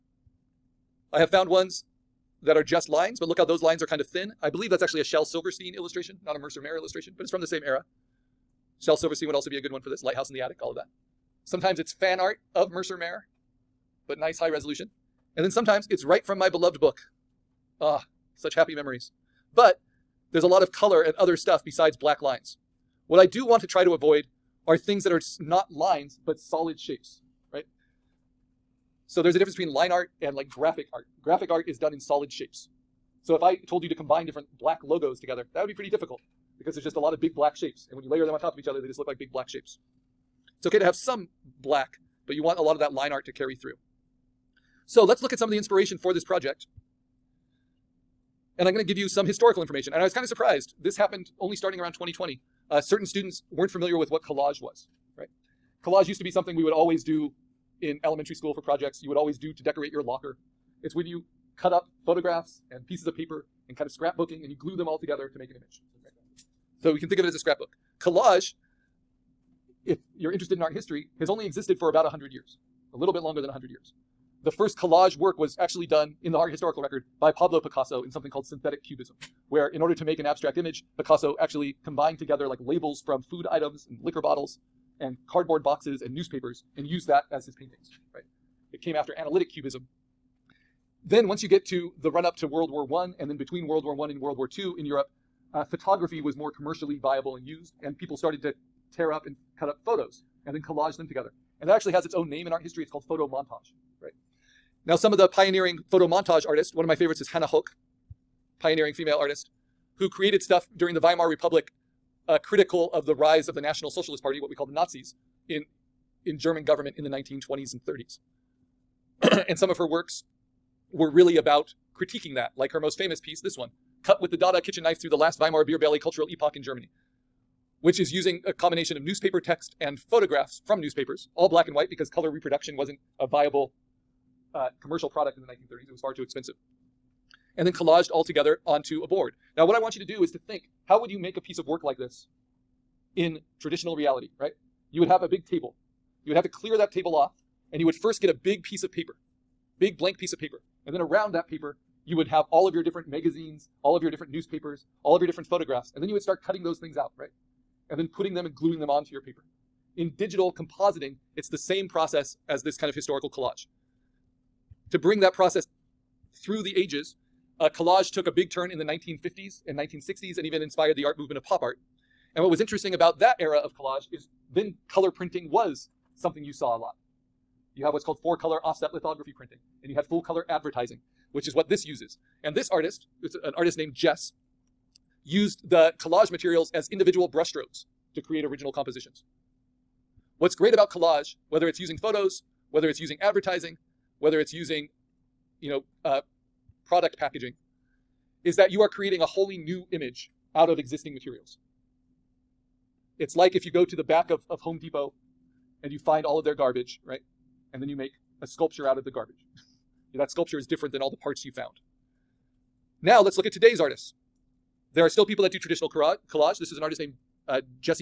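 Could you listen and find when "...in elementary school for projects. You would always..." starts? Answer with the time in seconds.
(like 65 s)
57 s.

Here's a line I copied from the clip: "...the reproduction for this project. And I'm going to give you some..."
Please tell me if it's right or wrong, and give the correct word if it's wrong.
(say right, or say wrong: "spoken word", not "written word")
wrong: "inspiration", not "reproduction".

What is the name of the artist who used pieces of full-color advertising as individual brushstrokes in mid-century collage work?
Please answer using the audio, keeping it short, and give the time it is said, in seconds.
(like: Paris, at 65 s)
Jess, at 183 s.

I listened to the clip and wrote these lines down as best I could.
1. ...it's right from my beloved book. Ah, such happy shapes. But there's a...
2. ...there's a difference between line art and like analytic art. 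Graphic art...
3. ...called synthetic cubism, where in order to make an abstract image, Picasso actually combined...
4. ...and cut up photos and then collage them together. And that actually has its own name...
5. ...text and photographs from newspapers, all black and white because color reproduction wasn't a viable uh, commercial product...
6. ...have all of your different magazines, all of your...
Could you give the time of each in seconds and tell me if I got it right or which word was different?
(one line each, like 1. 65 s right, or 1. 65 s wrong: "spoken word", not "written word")
1. 15 s wrong: "memories", not "shapes"
2. 29 s wrong: "graphic", not "analytic"
3. 78 s right
4. 99 s right
5. 129 s right
6. 152 s right.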